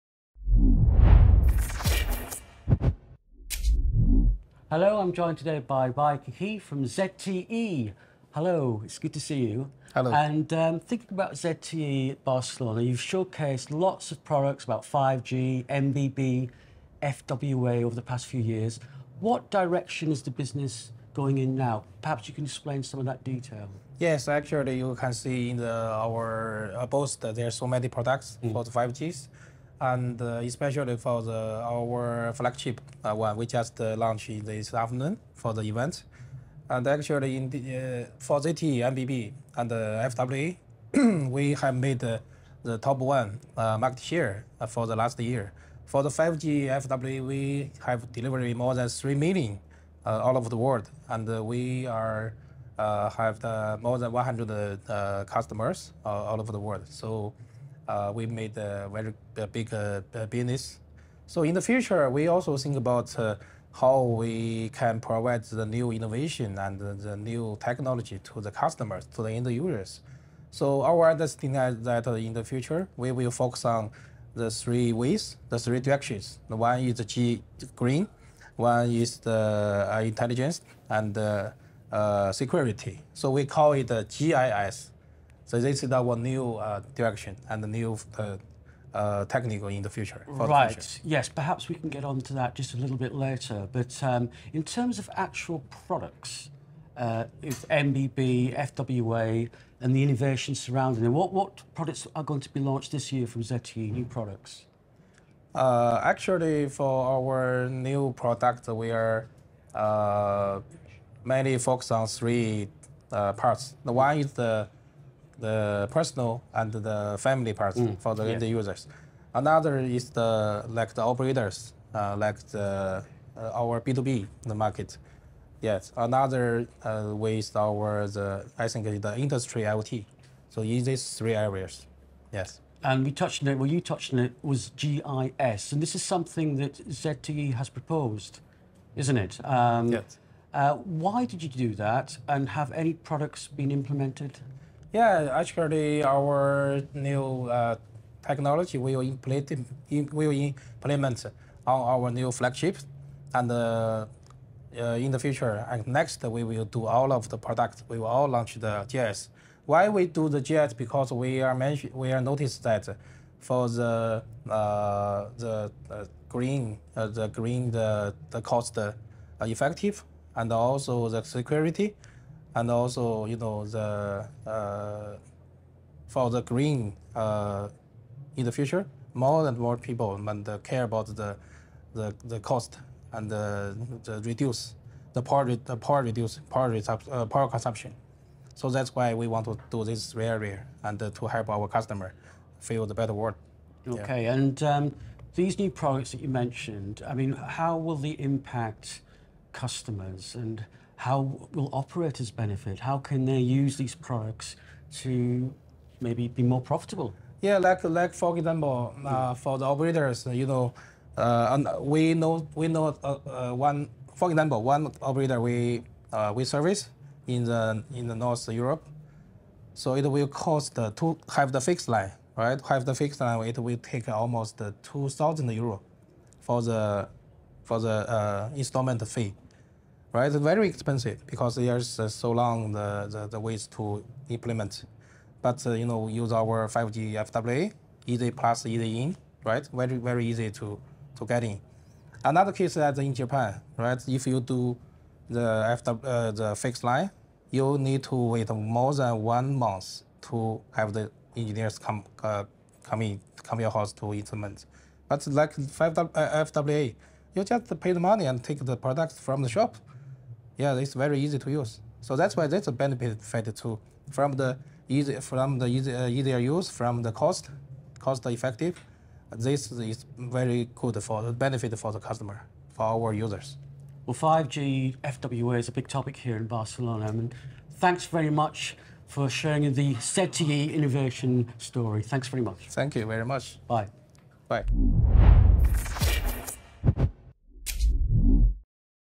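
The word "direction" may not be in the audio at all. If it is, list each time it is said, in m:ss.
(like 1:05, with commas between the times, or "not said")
0:19, 1:15, 1:26.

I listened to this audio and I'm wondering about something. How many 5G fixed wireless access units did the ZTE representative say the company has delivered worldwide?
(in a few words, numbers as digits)
More than 3 million.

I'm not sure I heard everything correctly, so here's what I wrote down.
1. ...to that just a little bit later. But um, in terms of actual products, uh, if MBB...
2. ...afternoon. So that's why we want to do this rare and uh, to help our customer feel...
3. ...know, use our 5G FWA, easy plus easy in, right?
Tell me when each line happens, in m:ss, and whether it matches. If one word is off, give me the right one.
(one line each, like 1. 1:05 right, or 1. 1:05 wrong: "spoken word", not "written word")
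1. 1:32 right
2. 3:07 wrong: "consumption", not "afternoon"
3. 3:55 right.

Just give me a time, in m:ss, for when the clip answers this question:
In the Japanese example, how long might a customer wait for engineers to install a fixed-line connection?
4:08.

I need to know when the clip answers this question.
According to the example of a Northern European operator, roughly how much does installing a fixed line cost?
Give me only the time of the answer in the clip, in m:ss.
3:44.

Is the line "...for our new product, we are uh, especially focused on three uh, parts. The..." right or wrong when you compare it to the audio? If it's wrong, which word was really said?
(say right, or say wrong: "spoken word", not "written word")
wrong: "mainly", not "especially".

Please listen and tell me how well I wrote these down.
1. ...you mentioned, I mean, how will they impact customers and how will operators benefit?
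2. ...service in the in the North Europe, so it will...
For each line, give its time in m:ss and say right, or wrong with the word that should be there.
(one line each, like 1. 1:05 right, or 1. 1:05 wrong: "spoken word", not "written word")
1. 3:16 right
2. 3:36 right.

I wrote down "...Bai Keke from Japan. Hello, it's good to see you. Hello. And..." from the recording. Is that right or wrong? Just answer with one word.
wrong.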